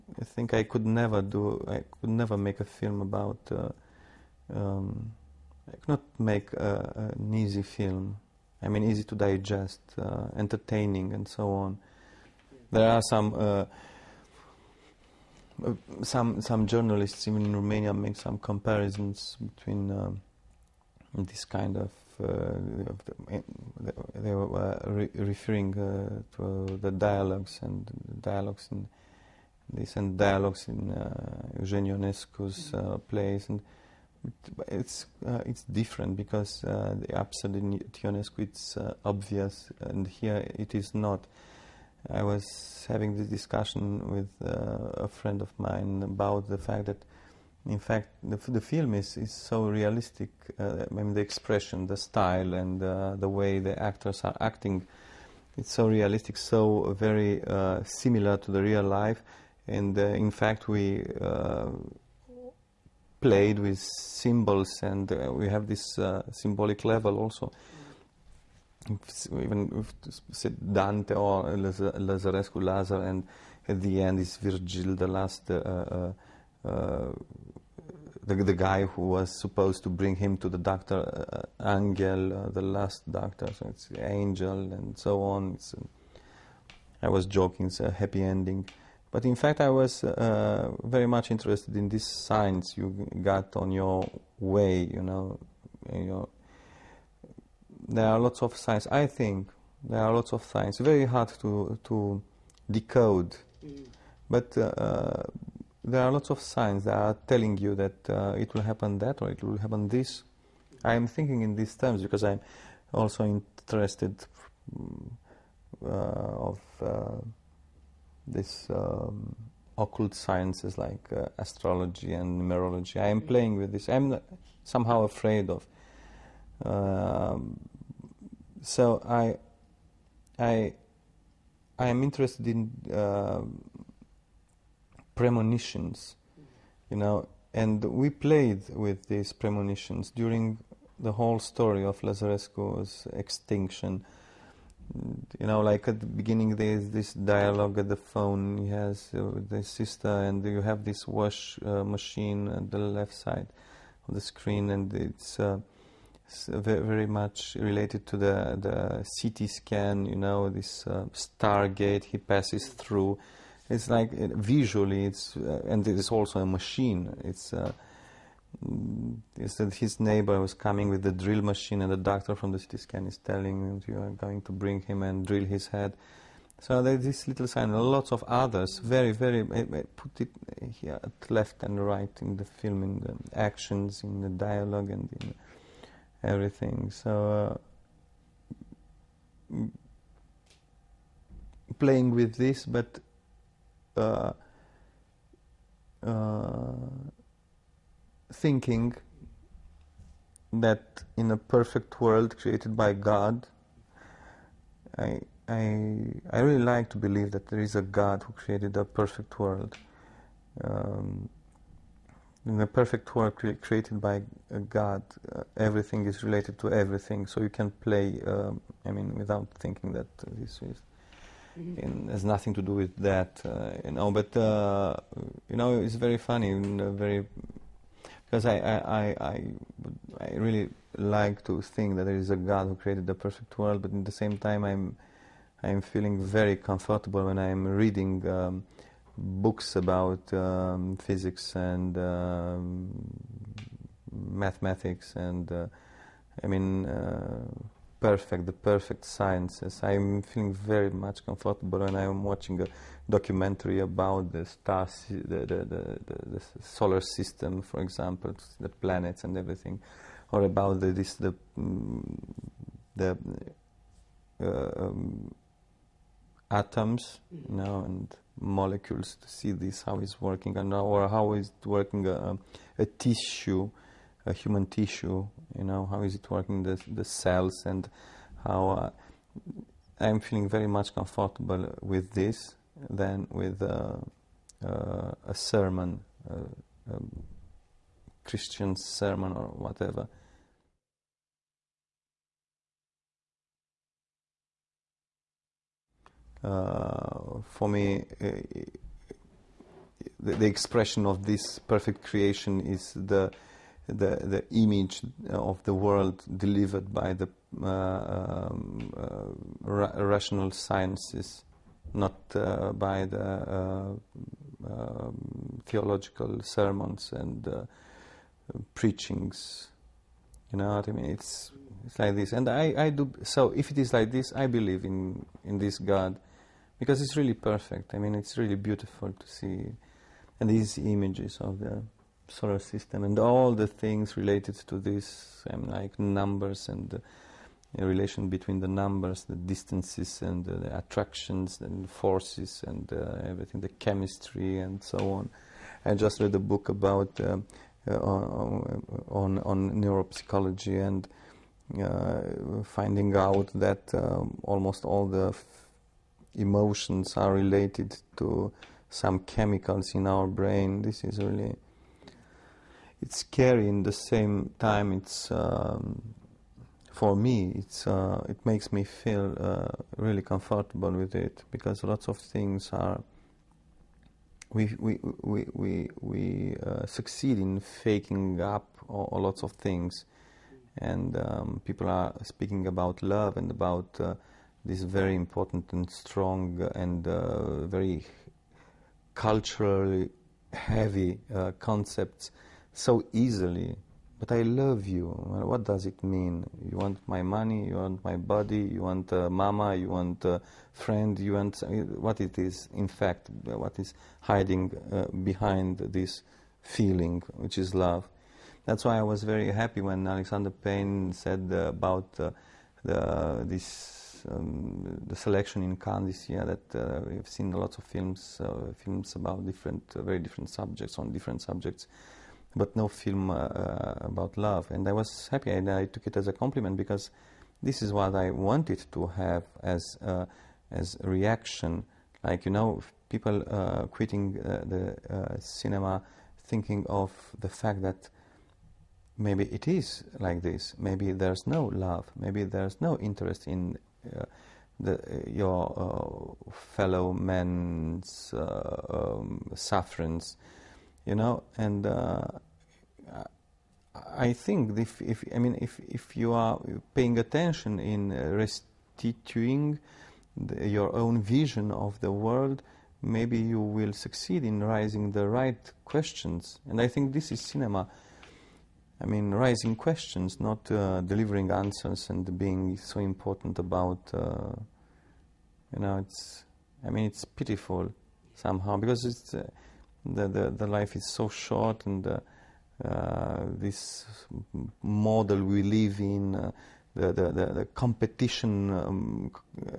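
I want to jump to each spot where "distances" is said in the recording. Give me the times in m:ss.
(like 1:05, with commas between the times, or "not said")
5:39.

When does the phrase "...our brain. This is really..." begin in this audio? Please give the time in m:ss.
6:00.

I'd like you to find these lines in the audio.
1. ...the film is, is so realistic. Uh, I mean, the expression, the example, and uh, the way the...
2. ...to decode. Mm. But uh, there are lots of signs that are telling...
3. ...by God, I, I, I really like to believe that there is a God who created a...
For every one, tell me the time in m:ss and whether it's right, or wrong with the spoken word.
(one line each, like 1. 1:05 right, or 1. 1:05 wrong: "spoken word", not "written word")
1. 0:48 wrong: "style", not "example"
2. 1:41 right
3. 3:22 right.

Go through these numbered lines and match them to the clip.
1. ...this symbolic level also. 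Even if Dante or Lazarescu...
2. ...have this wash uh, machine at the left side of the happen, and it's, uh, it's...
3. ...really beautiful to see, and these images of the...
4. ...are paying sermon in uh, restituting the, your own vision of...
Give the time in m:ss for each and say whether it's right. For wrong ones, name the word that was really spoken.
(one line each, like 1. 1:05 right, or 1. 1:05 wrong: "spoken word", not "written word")
1. 1:05 right
2. 2:30 wrong: "screen", not "happen"
3. 5:28 right
4. 7:36 wrong: "attention", not "sermon".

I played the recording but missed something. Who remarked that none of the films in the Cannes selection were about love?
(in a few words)
Alexander Payne.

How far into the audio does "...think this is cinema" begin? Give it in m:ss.
7:46.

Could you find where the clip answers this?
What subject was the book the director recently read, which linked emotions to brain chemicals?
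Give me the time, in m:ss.
5:49.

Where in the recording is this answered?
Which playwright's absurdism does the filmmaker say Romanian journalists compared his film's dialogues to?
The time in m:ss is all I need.
0:38.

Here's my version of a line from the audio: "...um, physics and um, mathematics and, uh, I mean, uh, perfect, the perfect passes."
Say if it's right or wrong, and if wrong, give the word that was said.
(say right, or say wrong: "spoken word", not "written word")
wrong: "sciences", not "passes".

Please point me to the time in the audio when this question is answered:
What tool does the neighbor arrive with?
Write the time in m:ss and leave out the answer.
2:51.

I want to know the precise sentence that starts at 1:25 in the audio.
It's, um, I was joking, it's a happy ending.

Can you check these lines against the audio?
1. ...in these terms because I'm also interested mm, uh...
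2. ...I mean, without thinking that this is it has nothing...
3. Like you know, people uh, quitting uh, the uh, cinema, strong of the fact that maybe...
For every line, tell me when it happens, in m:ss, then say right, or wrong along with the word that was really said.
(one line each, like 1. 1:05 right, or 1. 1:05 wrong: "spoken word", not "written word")
1. 1:51 right
2. 3:38 right
3. 7:12 wrong: "thinking", not "strong".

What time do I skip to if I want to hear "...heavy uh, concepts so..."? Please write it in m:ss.
6:30.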